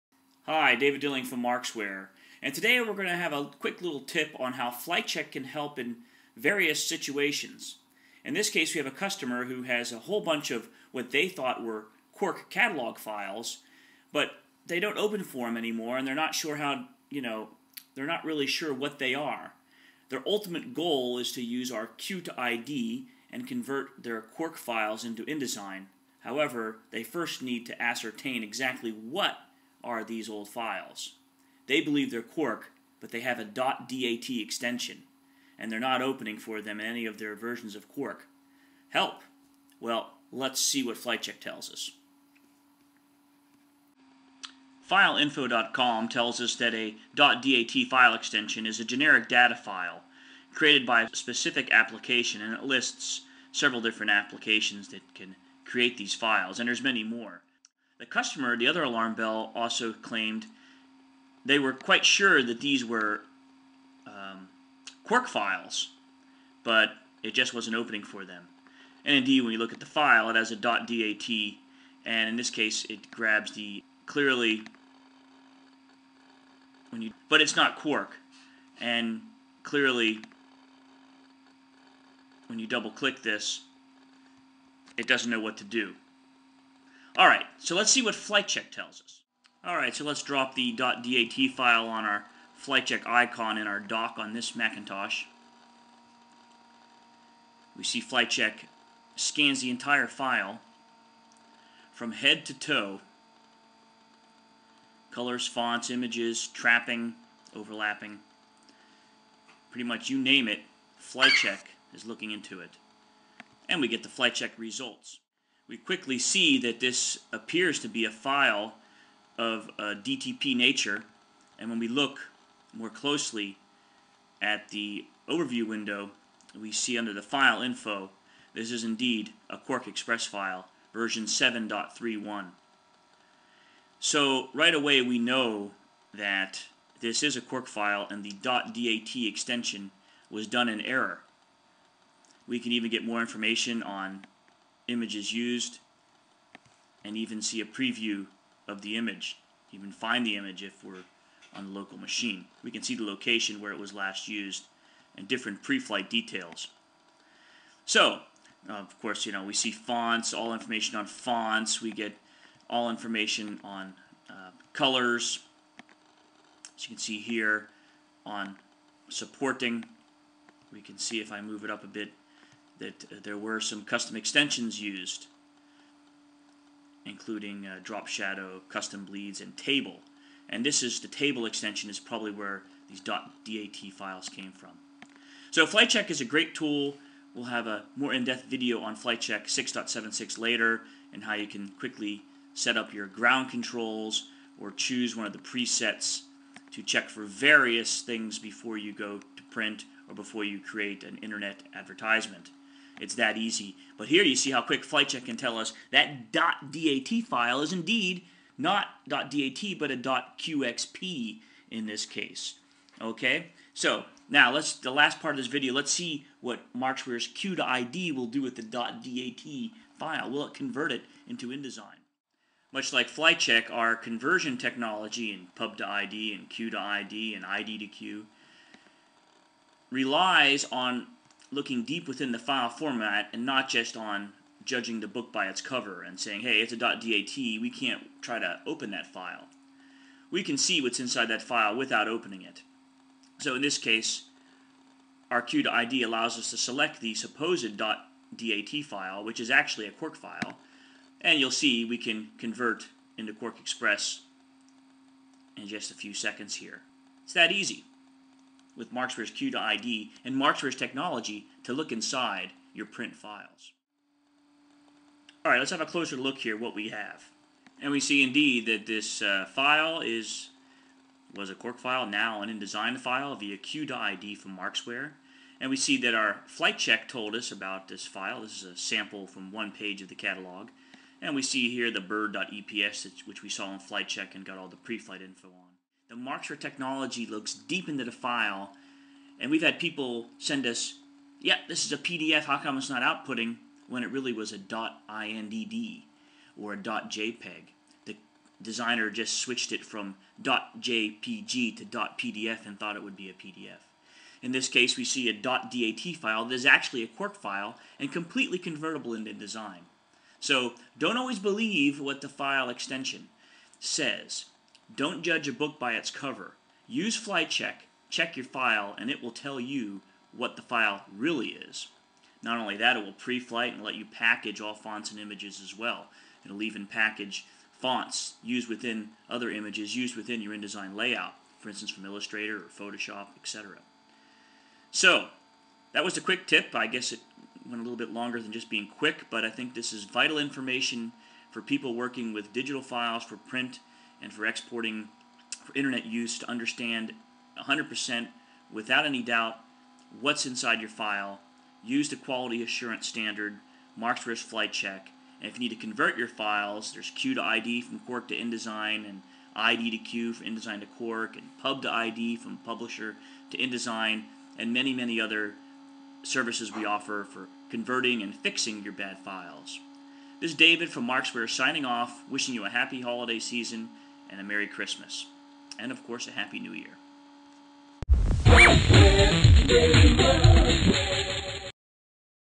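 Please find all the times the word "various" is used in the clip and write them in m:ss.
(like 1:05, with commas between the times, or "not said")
0:06, 3:17.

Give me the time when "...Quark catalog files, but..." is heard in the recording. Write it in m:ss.
0:12.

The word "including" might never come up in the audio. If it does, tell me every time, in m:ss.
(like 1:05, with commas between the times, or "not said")
2:57.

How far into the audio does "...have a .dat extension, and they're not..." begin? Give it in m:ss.
0:33.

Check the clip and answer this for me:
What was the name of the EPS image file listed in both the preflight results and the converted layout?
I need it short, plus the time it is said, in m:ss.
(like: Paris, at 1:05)
bird.eps, at 4:42.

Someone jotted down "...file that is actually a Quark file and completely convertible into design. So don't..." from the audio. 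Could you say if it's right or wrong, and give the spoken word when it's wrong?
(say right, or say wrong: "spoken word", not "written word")
right.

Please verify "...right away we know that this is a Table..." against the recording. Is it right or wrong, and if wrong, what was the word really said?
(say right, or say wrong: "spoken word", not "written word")
wrong: "Quark", not "Table".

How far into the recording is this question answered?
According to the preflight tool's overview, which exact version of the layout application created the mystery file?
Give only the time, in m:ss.
2:10.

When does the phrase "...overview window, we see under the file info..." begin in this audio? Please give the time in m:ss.
2:05.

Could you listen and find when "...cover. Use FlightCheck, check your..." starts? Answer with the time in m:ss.
5:16.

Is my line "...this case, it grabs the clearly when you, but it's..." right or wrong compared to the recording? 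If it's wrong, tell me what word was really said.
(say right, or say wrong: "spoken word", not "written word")
right.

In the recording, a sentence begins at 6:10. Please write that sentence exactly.
This is David from Markzware signing off, wishing you a happy holiday season and a Merry Christmas.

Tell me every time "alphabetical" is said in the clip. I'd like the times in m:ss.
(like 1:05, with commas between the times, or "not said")
not said.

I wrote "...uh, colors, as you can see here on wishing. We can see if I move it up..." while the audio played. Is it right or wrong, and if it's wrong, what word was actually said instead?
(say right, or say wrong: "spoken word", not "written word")
wrong: "supporting", not "wishing".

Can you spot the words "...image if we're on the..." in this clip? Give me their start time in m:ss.
2:30.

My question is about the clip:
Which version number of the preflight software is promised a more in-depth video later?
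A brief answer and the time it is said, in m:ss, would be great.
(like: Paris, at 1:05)
6.76, at 3:08.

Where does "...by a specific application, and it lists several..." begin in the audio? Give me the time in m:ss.
0:50.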